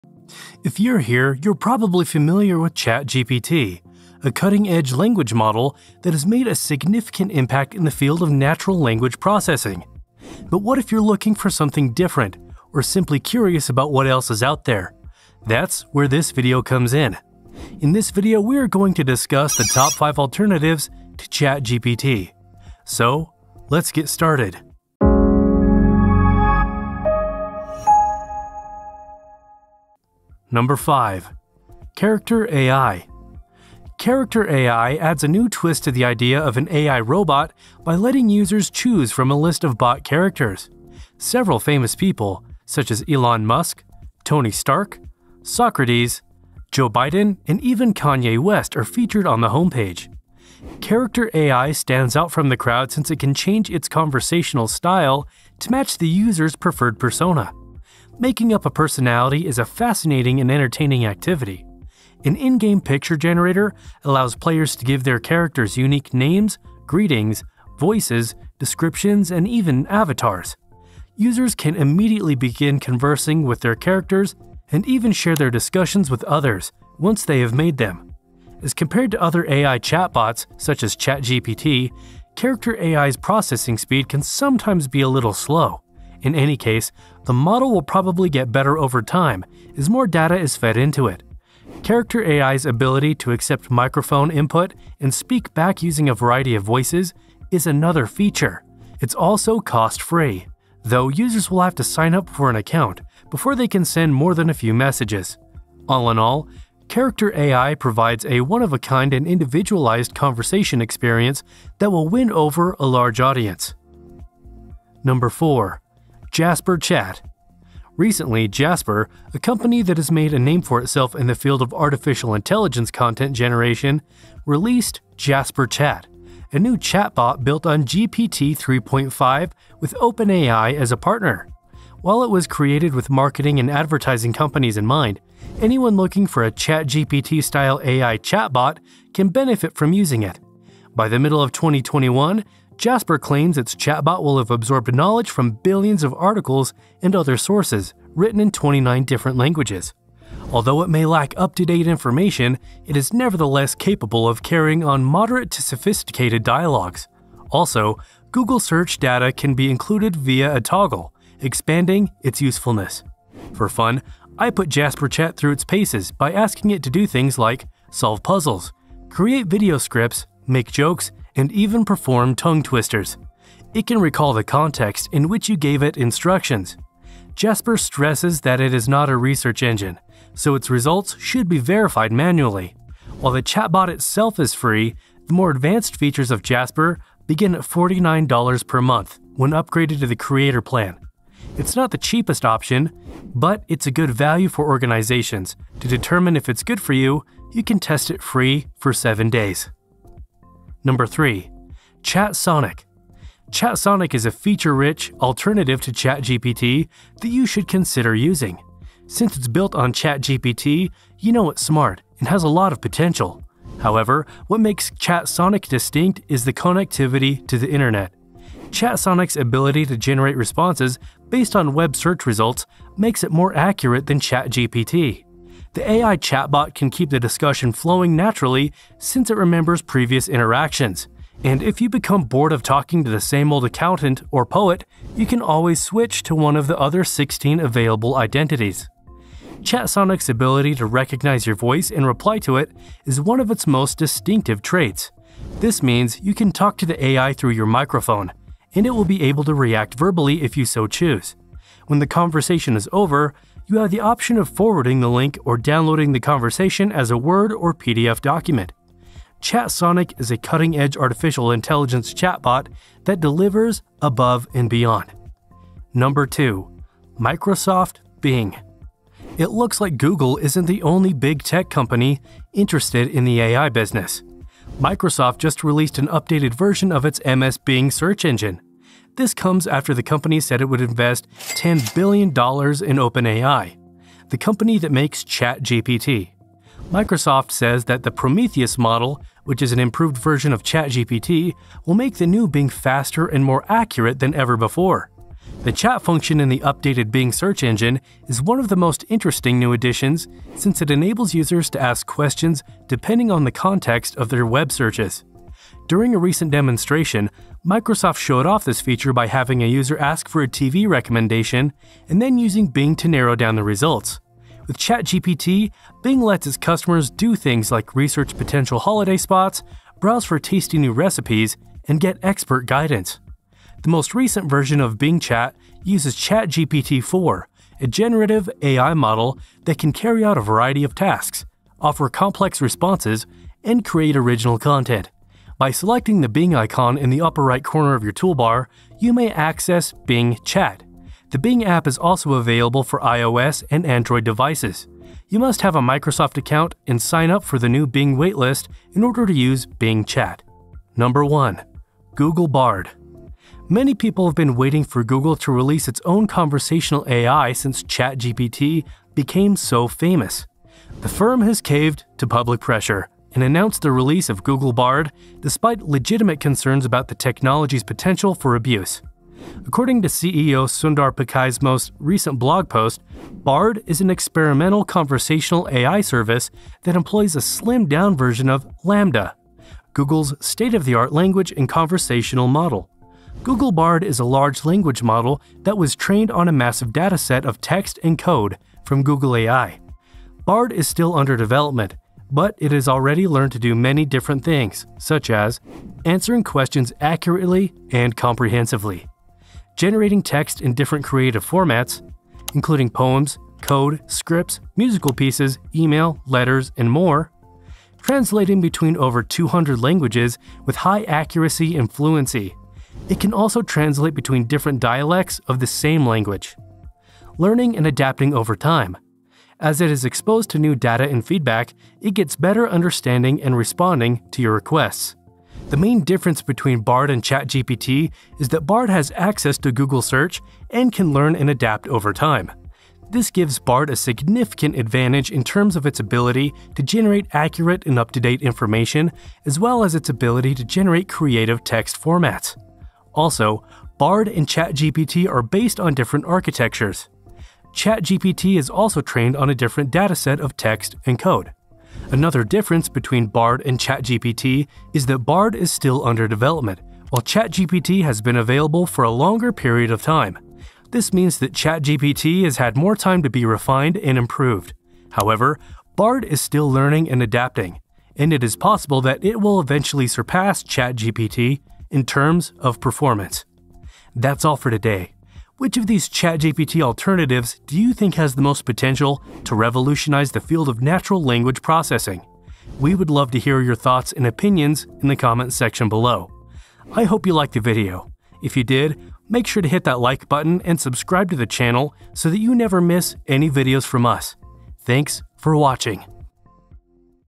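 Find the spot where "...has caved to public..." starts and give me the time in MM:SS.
06:01.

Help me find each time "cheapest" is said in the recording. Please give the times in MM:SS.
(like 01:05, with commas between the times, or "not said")
03:11.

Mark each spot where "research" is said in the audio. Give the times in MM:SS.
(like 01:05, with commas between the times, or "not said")
02:59, 05:17.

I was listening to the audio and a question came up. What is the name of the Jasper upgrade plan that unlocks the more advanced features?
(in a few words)
Creator plan.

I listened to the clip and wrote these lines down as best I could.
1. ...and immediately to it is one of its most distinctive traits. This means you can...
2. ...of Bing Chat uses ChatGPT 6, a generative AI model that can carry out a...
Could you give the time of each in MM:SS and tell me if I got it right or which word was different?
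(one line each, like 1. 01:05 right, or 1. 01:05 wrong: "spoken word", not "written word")
1. 04:01 wrong: "reply", not "immediately"
2. 05:24 wrong: "4", not "6".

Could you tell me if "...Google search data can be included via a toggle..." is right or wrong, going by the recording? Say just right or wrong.
right.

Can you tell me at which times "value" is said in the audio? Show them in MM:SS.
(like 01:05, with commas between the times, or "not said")
03:14.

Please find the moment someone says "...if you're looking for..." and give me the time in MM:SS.
00:10.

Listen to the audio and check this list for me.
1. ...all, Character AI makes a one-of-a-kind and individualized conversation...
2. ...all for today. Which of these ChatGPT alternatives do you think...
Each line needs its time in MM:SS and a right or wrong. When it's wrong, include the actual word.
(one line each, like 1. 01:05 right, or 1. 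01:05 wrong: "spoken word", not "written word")
1. 01:46 wrong: "provides", not "makes"
2. 07:54 right.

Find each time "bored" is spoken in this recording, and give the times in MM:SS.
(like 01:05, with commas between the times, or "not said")
03:52.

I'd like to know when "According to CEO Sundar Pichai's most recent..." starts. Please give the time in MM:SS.
06:09.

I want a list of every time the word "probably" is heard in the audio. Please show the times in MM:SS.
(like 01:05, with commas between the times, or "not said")
00:01, 01:27.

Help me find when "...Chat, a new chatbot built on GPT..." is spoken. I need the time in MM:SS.
02:05.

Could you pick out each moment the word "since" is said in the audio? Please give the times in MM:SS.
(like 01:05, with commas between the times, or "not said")
00:52, 03:29, 03:48, 05:00, 05:57.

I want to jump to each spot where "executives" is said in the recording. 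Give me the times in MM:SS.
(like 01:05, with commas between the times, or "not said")
not said.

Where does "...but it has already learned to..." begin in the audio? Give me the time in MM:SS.
06:32.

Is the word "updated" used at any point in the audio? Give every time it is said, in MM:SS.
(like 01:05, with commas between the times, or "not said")
04:36, 04:56.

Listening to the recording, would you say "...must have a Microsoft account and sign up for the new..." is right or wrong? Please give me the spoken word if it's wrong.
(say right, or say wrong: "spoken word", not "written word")
right.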